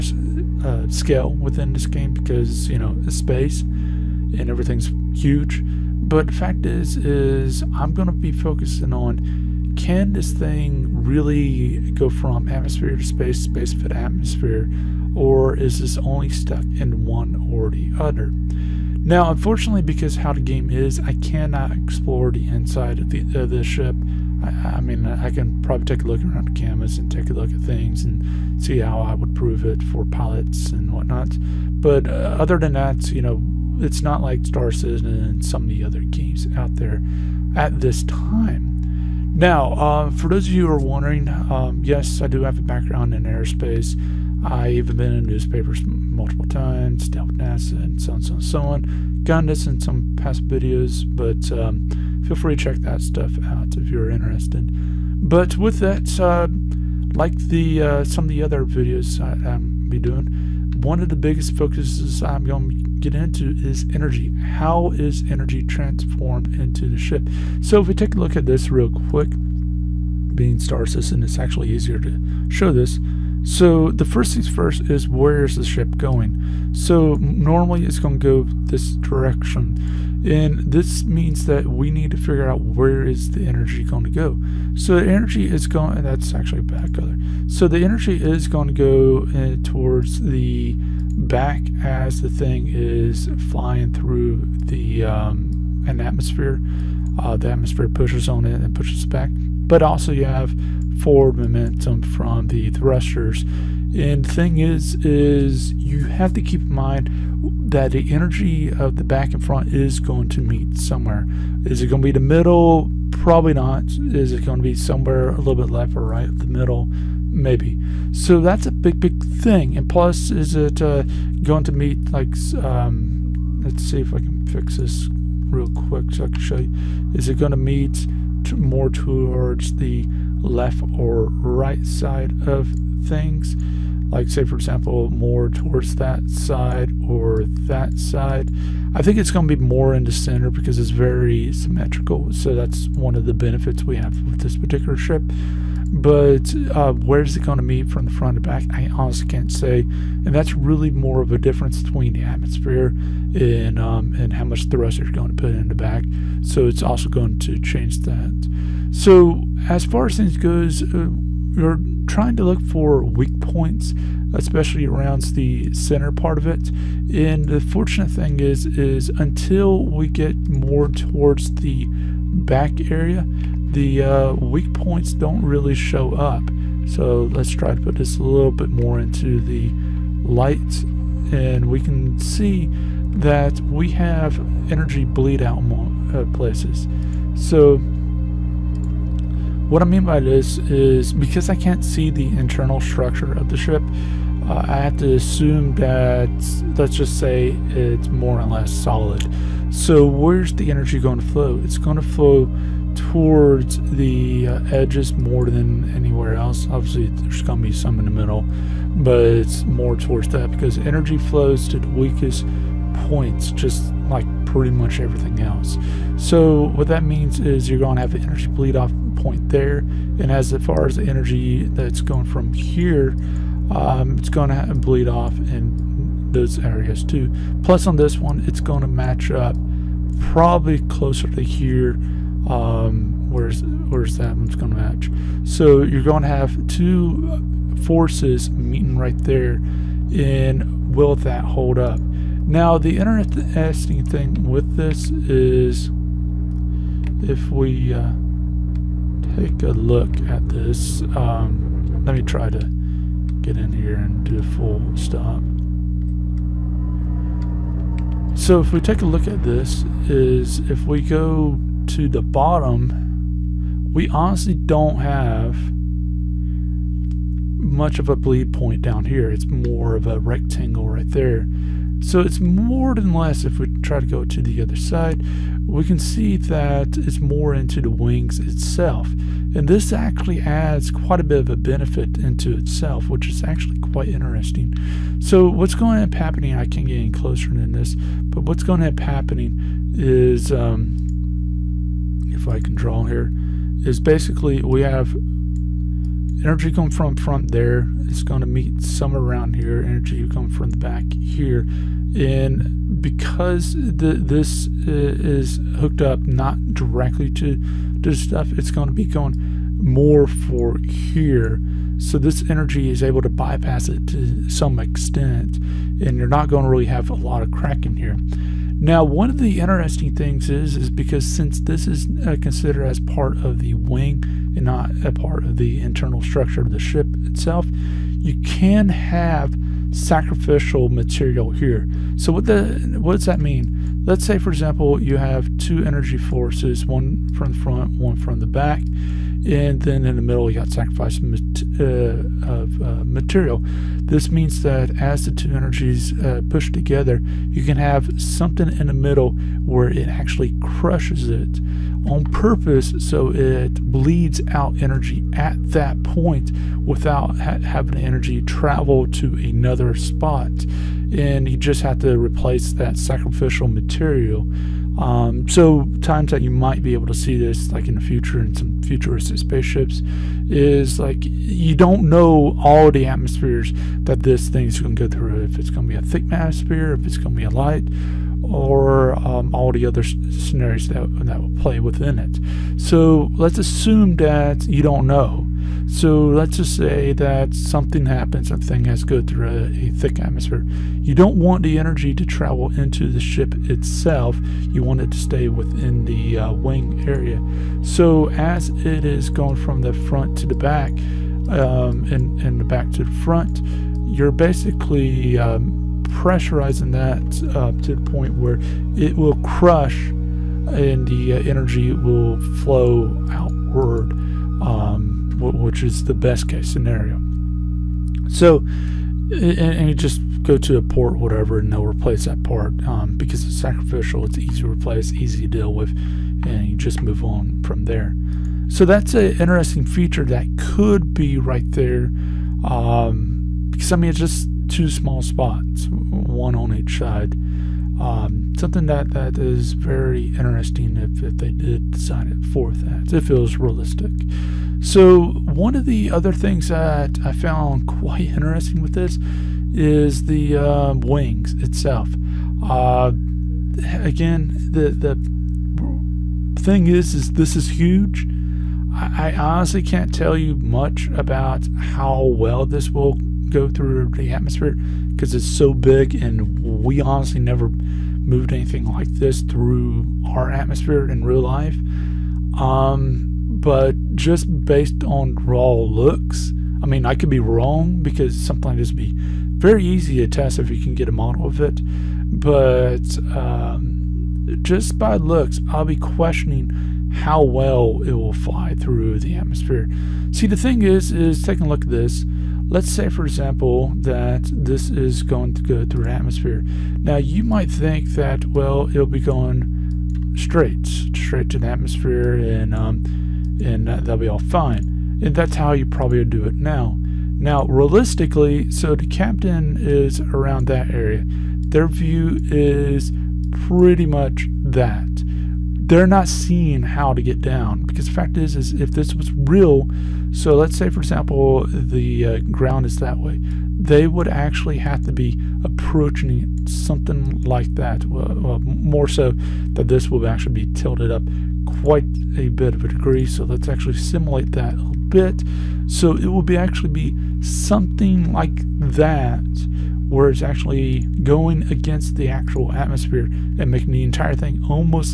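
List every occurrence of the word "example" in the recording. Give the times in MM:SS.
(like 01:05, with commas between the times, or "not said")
02:14, 05:34, 08:13, 08:40.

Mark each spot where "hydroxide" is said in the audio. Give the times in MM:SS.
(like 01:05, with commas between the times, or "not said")
not said.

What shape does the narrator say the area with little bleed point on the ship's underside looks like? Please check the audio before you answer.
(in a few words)
A rectangle.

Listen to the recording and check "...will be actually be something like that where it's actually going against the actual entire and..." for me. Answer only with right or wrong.
wrong.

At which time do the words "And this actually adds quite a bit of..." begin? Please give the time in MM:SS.
04:39.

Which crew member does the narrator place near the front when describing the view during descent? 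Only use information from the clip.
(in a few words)
The captain.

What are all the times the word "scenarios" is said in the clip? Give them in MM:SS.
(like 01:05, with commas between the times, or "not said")
06:20, 06:56.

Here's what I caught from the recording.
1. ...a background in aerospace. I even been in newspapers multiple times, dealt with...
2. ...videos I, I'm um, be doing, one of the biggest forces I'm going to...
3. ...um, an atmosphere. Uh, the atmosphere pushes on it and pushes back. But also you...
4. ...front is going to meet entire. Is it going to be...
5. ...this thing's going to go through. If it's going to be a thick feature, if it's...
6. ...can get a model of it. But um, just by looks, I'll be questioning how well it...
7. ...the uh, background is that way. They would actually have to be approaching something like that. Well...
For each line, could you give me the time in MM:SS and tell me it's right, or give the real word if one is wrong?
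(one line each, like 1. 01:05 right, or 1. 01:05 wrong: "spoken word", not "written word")
1. 00:42 right
2. 00:58 wrong: "focuses", not "forces"
3. 01:35 right
4. 01:49 wrong: "somewhere", not "entire"
5. 06:14 wrong: "atmosphere", not "feature"
6. 08:00 right
7. 08:41 wrong: "ground", not "background".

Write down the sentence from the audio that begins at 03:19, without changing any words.
So where's the energy going to flow?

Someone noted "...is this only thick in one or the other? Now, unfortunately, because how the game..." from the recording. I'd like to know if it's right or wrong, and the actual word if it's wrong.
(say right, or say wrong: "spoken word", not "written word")
wrong: "stuck", not "thick".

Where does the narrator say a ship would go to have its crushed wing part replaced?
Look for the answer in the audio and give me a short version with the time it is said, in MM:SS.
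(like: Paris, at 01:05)
A port, at 07:00.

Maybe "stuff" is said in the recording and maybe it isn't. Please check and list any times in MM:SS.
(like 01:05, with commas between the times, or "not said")
00:53, 05:08.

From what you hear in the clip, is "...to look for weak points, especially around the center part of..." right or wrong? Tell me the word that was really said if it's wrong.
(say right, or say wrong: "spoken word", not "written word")
right.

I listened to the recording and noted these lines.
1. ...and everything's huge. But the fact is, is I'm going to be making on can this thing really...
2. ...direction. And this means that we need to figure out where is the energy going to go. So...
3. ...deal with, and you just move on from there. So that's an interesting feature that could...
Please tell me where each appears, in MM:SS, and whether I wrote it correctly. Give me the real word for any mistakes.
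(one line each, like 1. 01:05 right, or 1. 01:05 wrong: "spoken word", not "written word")
1. 00:04 wrong: "focusing", not "making"
2. 01:18 right
3. 07:05 right.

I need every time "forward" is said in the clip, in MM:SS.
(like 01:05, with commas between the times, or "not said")
01:40.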